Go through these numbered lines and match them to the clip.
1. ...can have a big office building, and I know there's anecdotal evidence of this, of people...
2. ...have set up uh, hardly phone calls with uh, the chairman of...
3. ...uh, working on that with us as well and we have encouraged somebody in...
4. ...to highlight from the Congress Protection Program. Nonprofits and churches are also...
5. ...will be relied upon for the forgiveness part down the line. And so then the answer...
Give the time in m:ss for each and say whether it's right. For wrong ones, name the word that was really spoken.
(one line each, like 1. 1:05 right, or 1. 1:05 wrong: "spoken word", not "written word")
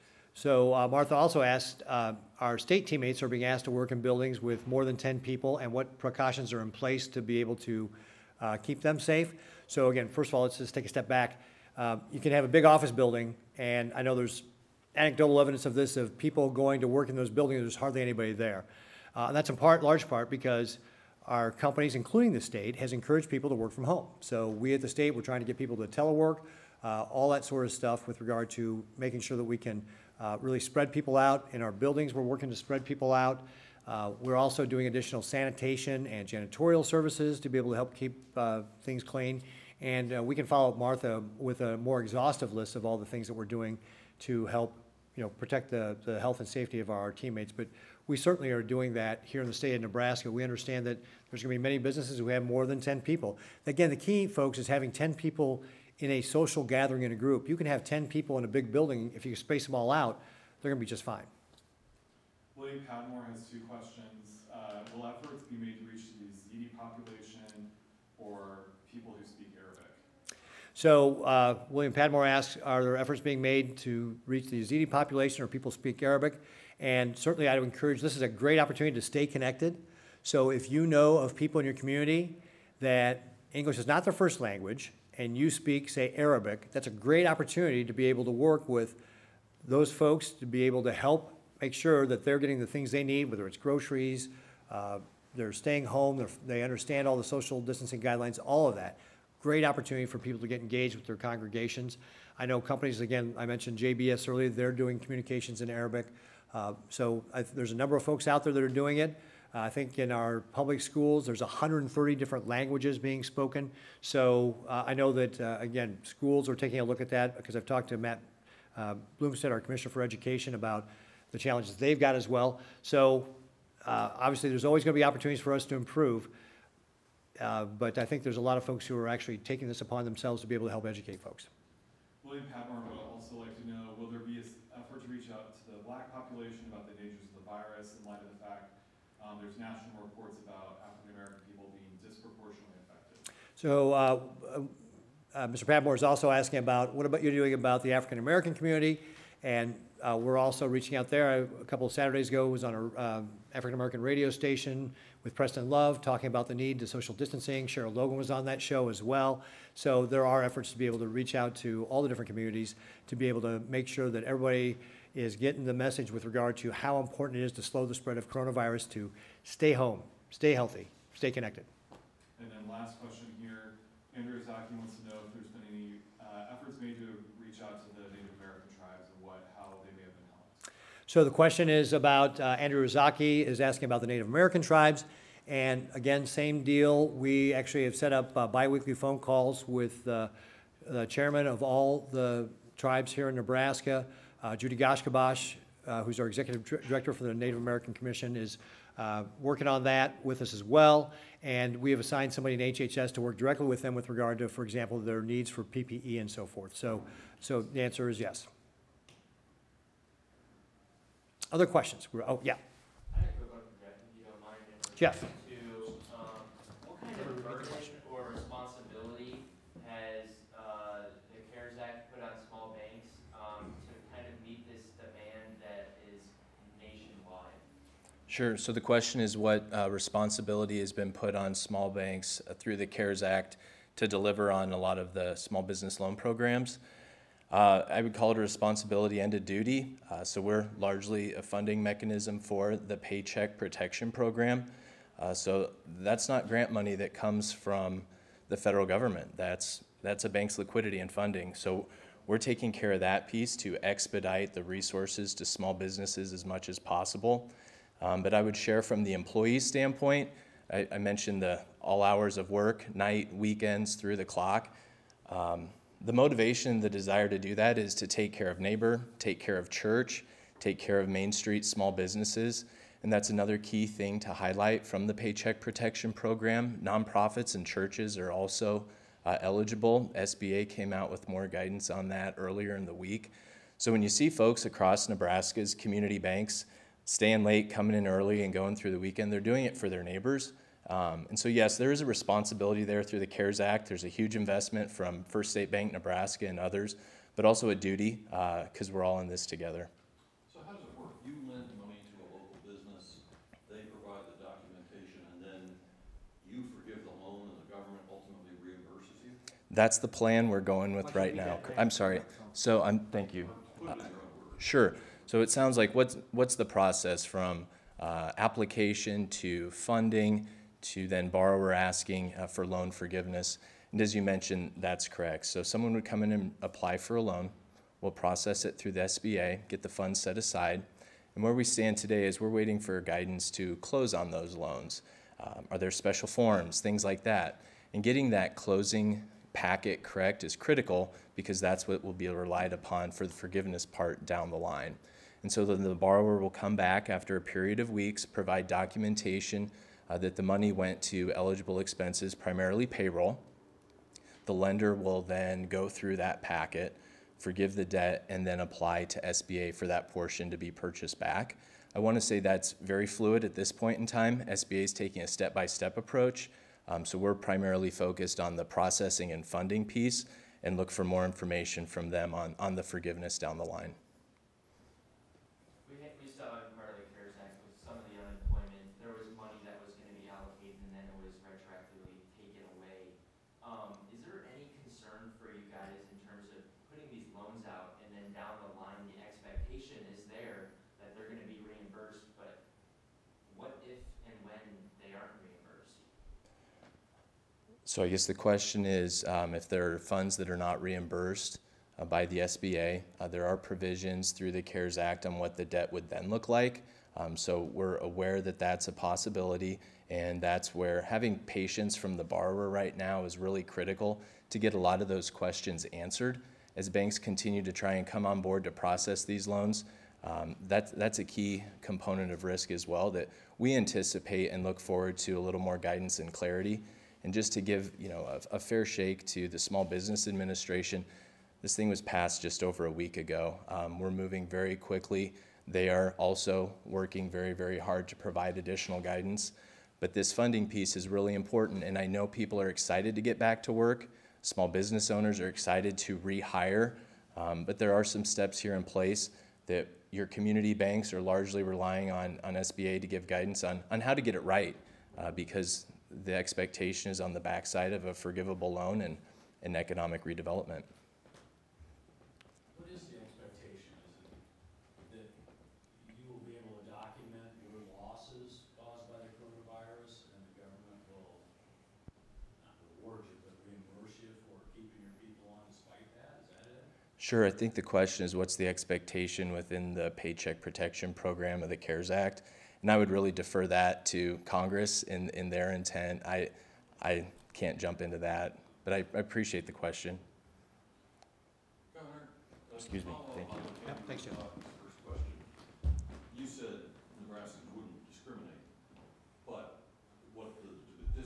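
1. 0:12 right
2. 3:07 wrong: "biweekly", not "hardly"
3. 3:18 wrong: "assigned", not "encouraged"
4. 4:34 wrong: "Paycheck", not "Congress"
5. 5:42 wrong: "borrower", not "answer".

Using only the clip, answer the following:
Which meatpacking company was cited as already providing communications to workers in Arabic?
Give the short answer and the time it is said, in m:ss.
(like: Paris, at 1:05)
JBS, at 1:43.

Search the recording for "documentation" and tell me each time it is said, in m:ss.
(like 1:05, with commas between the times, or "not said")
5:04, 5:48.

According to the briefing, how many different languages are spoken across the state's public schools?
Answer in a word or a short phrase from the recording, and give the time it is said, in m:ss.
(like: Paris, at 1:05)
130, at 1:51.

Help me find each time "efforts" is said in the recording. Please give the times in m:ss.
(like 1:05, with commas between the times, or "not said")
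1:05, 1:12, 2:40, 2:56.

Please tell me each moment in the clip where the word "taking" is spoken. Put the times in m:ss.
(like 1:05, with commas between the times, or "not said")
1:56, 2:09, 4:12, 6:04.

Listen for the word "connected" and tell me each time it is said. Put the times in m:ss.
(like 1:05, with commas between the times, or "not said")
1:19, 2:51.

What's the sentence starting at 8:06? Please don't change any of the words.
I, I can't jump into that, but I, I appreciate the question.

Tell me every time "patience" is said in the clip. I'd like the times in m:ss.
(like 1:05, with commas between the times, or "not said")
6:51.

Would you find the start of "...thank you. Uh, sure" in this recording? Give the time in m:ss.
5:13.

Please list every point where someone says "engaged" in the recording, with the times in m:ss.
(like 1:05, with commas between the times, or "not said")
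1:40.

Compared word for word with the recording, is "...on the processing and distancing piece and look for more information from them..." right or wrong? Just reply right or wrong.
wrong.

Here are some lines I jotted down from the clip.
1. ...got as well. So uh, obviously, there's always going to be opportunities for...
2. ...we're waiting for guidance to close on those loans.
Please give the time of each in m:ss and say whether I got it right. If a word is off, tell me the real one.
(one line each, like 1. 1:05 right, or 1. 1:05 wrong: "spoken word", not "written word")
1. 2:01 right
2. 5:32 right.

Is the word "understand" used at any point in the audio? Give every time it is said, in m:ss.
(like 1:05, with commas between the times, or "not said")
0:50, 1:36.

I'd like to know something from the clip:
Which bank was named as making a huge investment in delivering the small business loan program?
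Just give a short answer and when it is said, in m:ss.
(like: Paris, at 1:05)
First State Bank, at 4:55.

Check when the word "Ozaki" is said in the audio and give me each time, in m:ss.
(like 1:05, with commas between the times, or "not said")
2:54, 3:02.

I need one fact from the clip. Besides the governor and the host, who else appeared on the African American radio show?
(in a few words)
Cheryl Logan.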